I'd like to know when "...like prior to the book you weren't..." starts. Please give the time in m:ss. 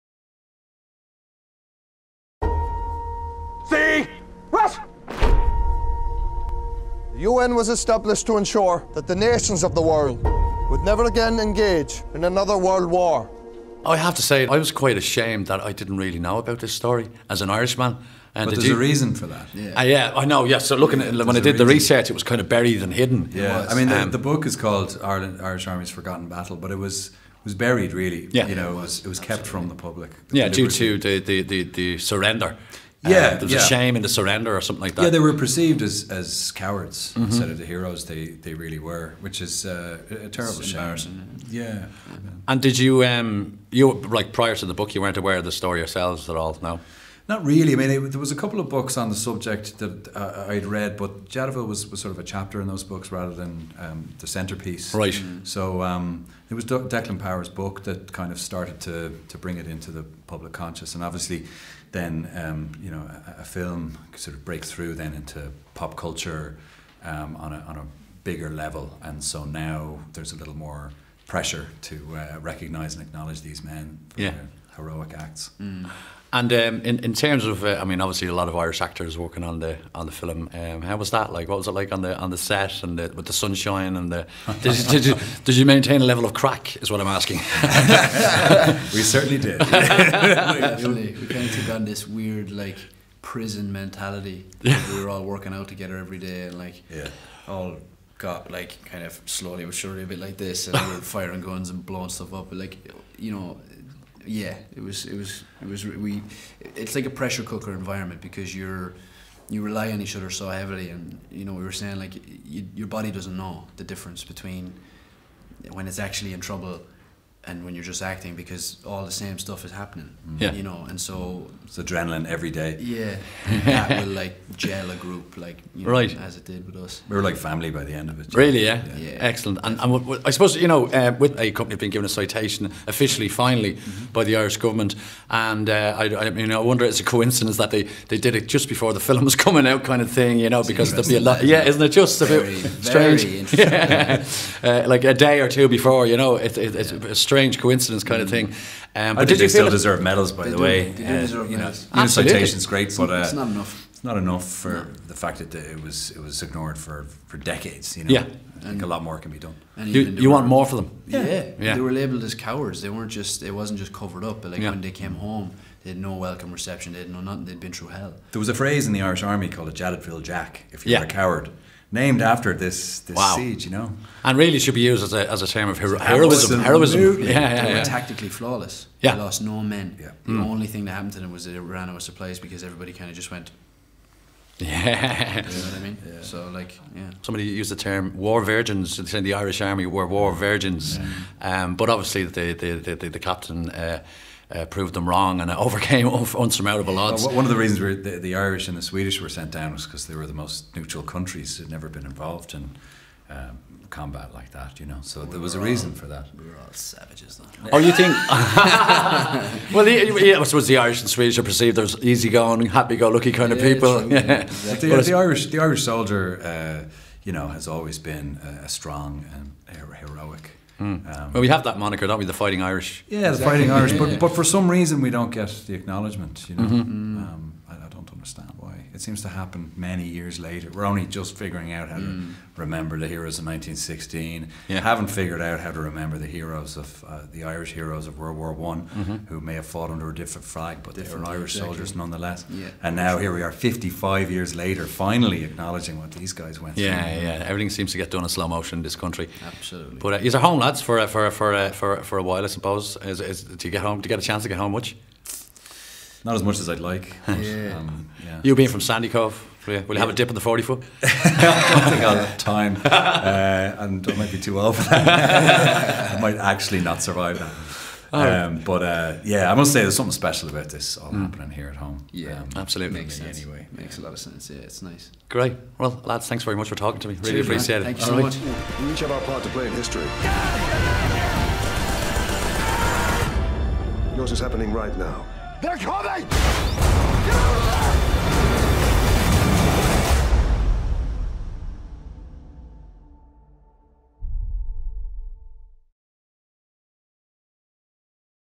0:43.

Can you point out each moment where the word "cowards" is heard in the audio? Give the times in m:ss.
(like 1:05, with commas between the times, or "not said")
0:36, 2:42, 2:51.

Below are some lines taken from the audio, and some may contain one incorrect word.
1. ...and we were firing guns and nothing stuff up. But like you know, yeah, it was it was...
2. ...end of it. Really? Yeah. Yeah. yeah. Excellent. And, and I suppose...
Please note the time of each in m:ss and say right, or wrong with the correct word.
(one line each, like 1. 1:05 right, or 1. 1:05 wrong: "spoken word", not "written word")
1. 1:40 wrong: "blowing", not "nothing"
2. 2:07 right.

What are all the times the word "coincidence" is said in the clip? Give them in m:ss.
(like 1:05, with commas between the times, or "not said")
2:17, 2:27.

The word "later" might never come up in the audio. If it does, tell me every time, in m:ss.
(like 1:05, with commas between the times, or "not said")
3:50, 4:04.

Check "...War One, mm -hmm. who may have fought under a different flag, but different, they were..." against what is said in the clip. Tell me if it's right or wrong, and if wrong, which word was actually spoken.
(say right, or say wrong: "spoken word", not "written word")
right.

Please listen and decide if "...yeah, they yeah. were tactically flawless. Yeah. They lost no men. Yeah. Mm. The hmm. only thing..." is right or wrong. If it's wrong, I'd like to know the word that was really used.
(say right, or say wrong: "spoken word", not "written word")
right.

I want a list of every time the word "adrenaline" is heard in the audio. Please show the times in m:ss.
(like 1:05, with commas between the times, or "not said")
2:01.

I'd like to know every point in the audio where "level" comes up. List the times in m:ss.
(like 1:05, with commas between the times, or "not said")
1:08, 1:26.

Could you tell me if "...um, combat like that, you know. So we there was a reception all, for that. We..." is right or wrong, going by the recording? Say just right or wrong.
wrong.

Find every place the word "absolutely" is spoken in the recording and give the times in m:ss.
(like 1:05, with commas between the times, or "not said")
0:29, 2:32, 4:09, 4:32.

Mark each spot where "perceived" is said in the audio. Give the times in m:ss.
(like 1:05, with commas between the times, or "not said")
0:35, 3:31.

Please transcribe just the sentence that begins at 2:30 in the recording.
They do uh, deserve you medals.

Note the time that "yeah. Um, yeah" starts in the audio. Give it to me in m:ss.
4:17.